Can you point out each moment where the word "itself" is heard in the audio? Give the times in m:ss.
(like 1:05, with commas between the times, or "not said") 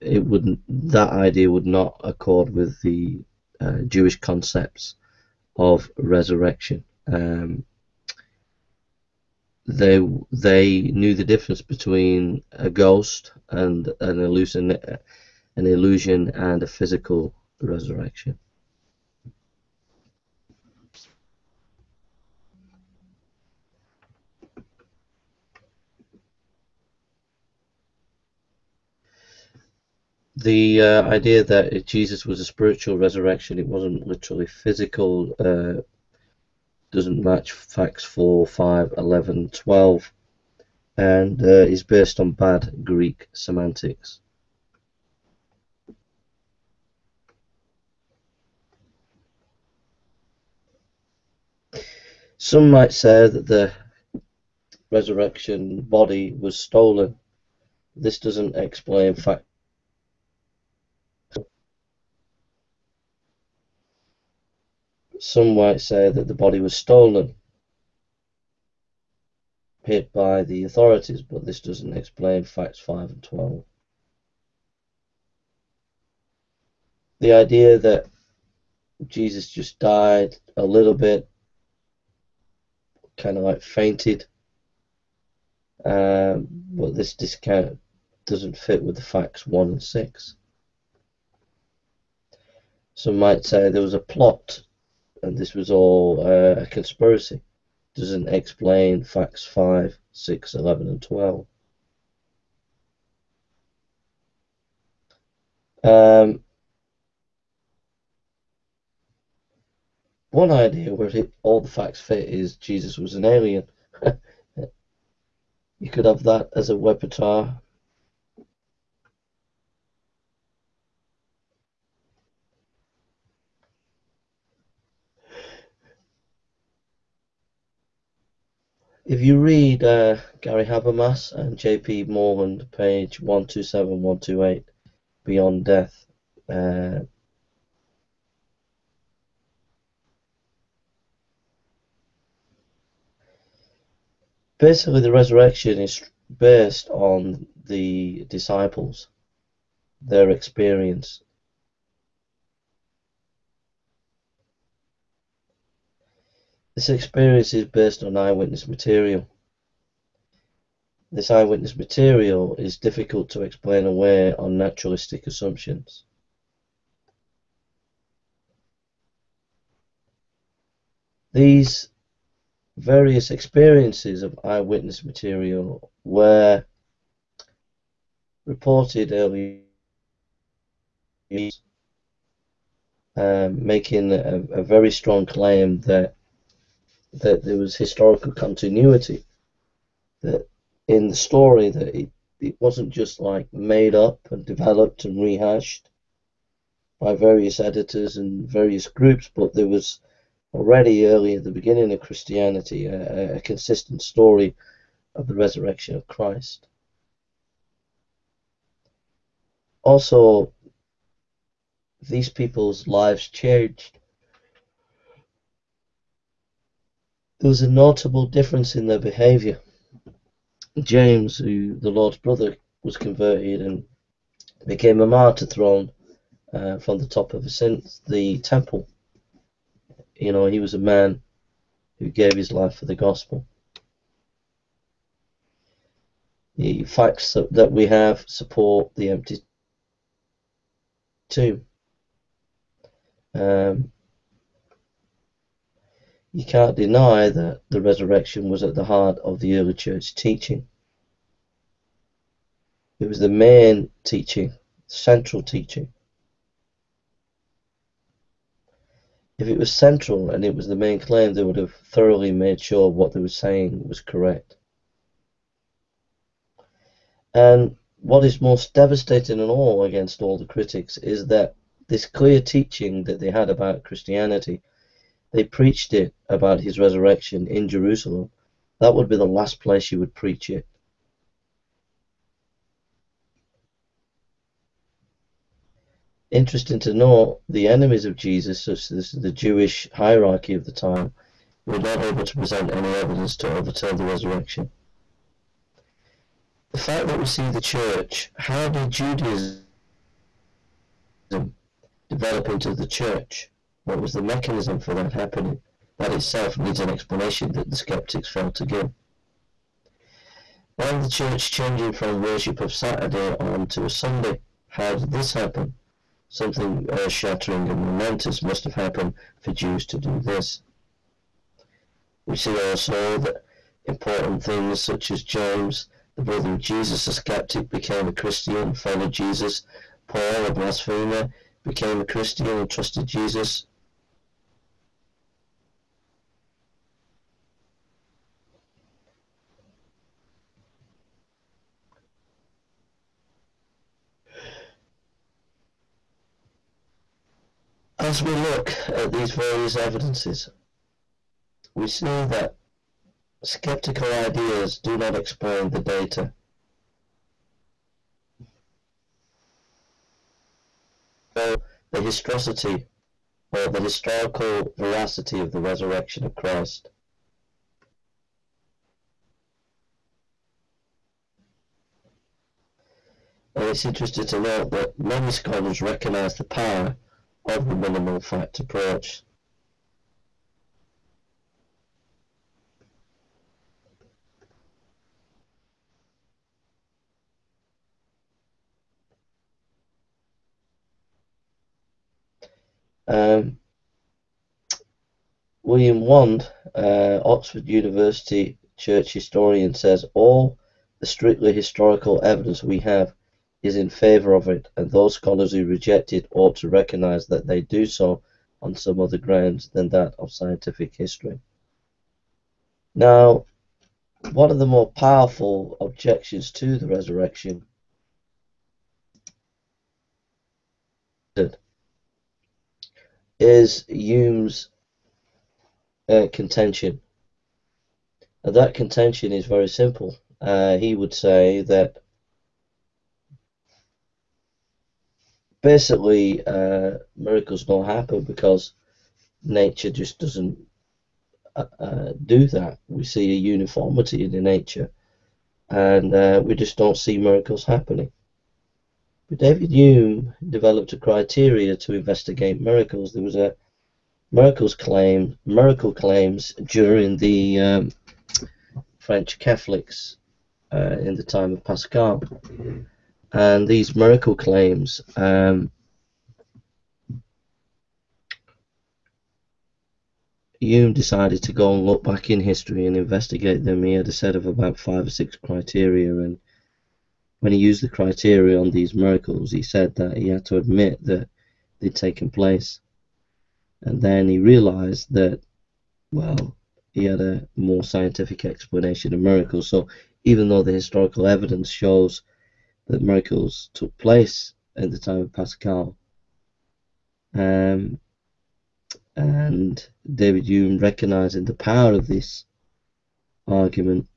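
5:06.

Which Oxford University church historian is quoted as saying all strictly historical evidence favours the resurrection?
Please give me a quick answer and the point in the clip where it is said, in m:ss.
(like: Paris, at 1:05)
William Wand, at 6:35.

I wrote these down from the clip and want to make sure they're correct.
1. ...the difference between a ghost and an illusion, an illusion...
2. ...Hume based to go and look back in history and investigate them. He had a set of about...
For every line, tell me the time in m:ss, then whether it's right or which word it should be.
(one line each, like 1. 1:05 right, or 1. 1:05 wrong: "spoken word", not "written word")
1. 0:11 right
2. 7:50 wrong: "decided", not "based".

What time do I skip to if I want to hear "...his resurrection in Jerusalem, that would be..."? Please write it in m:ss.
4:36.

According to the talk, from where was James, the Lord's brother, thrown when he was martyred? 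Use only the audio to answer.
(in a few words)
The top of the temple.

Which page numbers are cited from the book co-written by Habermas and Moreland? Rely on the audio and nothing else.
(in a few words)
127, 128.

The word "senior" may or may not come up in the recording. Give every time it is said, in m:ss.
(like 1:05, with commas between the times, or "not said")
not said.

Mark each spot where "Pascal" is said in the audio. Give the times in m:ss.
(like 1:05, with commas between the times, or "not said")
7:41, 8:15.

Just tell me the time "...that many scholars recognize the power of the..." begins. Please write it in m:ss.
6:14.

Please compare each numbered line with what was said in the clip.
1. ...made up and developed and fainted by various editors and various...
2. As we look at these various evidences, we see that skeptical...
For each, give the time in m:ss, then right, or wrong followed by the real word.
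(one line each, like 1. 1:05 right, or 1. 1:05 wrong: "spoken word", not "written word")
1. 3:13 wrong: "rehashed", not "fainted"
2. 5:47 right.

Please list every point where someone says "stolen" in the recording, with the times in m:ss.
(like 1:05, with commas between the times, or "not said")
0:56, 1:06.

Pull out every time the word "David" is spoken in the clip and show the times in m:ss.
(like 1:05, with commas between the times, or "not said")
7:29, 8:20.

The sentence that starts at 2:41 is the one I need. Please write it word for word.
This eyewitness material is difficult to explain away on naturalistic assumptions.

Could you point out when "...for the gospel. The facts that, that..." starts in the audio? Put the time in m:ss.
3:52.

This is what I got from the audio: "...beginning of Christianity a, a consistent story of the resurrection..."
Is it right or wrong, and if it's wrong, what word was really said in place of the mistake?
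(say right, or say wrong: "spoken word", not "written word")
right.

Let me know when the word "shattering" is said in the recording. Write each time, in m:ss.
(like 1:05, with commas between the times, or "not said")
5:17.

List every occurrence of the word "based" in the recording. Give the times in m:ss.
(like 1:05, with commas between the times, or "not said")
0:41, 2:26, 2:37.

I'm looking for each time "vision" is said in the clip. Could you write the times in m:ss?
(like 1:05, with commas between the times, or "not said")
not said.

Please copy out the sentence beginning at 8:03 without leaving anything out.
And then he realized that, well, he had a more scientific explanation of miracles.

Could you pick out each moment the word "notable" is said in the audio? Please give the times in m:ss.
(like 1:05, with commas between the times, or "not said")
3:37.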